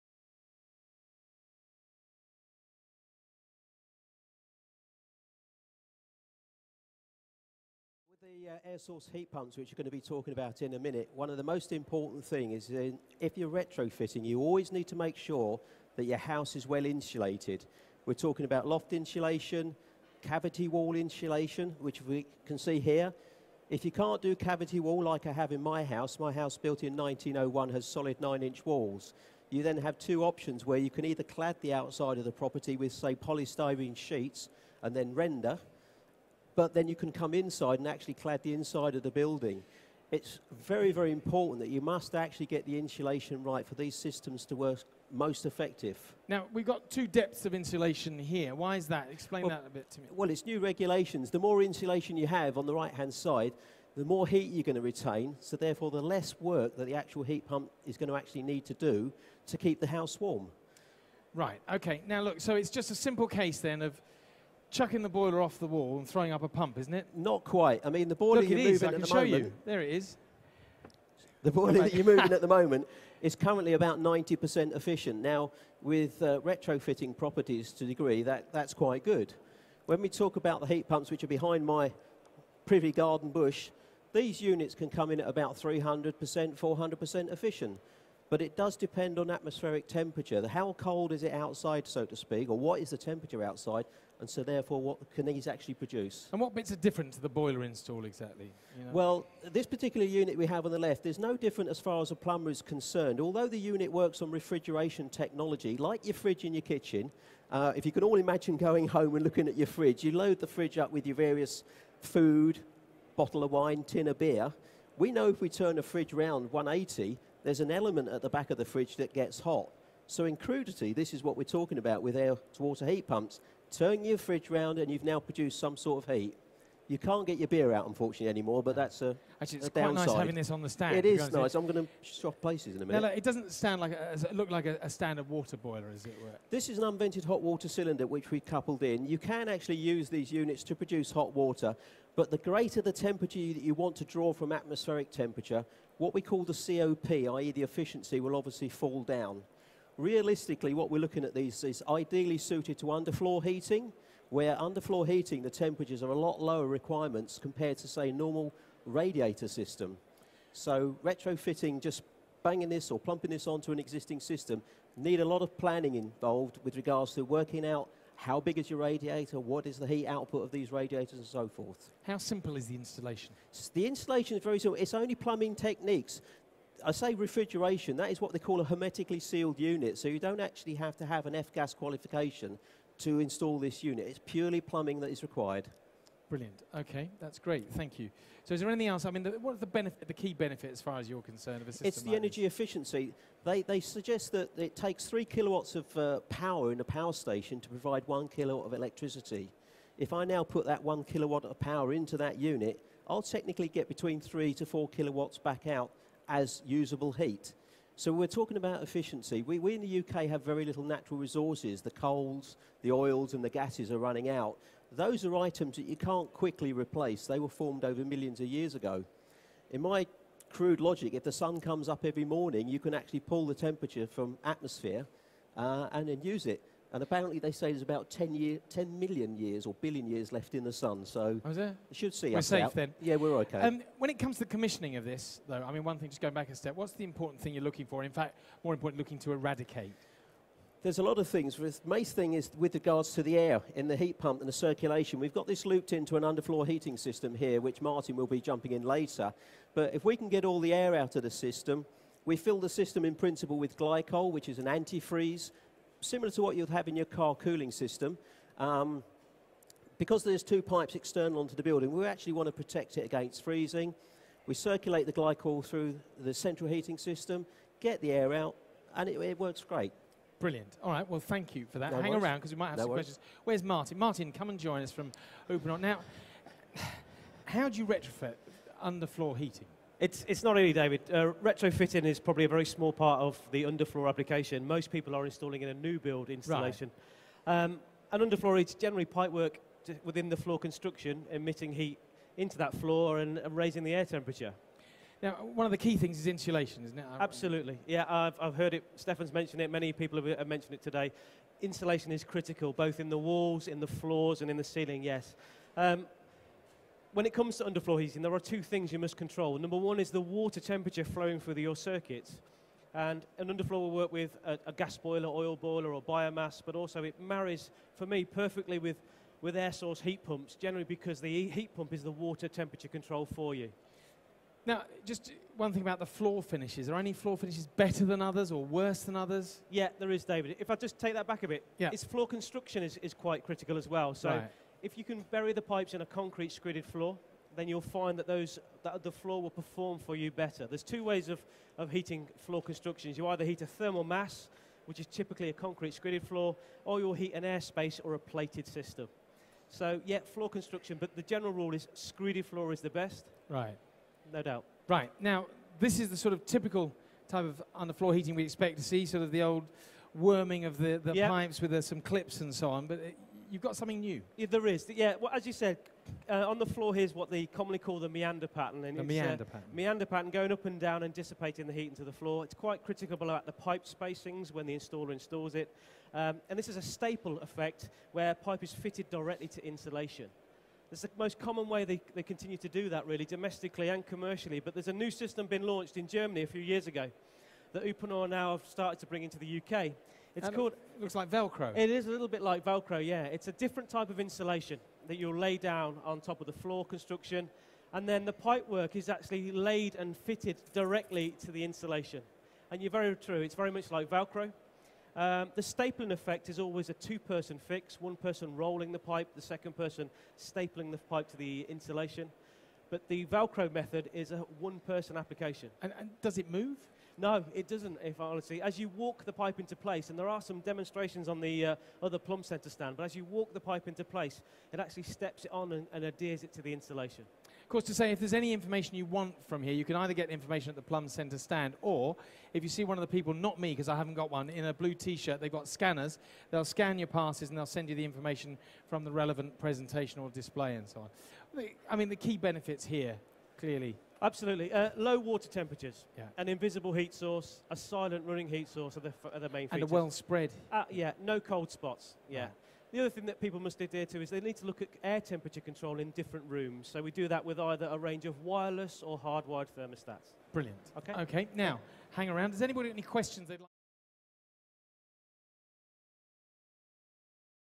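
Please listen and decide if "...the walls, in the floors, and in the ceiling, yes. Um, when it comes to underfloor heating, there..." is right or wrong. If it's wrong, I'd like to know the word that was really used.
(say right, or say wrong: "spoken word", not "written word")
right.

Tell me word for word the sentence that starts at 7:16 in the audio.
They'll scan your passes and they'll send you the information from the relevant presentation or display and so on.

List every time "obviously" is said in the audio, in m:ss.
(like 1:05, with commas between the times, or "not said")
2:28.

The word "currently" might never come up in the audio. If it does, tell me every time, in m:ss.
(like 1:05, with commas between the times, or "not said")
1:13.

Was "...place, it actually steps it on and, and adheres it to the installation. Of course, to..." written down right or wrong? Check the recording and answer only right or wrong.
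right.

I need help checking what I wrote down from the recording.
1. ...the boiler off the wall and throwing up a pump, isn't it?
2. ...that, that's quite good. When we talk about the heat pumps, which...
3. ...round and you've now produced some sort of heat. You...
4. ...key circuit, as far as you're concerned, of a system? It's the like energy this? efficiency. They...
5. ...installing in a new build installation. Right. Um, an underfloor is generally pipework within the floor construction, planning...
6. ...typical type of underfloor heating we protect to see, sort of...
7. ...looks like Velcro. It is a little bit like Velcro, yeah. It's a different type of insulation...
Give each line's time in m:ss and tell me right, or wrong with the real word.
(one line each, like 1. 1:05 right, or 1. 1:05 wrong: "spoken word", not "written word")
1. 1:05 right
2. 1:18 right
3. 2:04 right
4. 3:10 wrong: "benefit", not "circuit"
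5. 4:45 wrong: "emitting", not "planning"
6. 5:56 wrong: "expect", not "protect"
7. 6:31 right.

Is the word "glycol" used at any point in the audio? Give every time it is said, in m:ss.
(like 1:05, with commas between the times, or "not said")
4:13, 4:25.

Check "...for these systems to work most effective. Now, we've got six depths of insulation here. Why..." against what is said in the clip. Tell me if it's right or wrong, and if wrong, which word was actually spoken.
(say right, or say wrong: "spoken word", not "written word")
wrong: "two", not "six".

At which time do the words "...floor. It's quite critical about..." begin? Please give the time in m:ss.
6:12.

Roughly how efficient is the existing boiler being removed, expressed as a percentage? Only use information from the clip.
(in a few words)
90%.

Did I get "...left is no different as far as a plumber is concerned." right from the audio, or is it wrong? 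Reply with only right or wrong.
right.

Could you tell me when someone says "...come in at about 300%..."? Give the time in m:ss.
1:24.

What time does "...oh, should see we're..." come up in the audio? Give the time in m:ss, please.
3:51.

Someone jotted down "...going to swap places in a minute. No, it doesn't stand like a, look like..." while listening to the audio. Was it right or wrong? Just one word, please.
right.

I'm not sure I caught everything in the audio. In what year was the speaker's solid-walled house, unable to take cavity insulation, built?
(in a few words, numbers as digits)
1901.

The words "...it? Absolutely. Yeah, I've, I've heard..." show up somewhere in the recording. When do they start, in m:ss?
4:56.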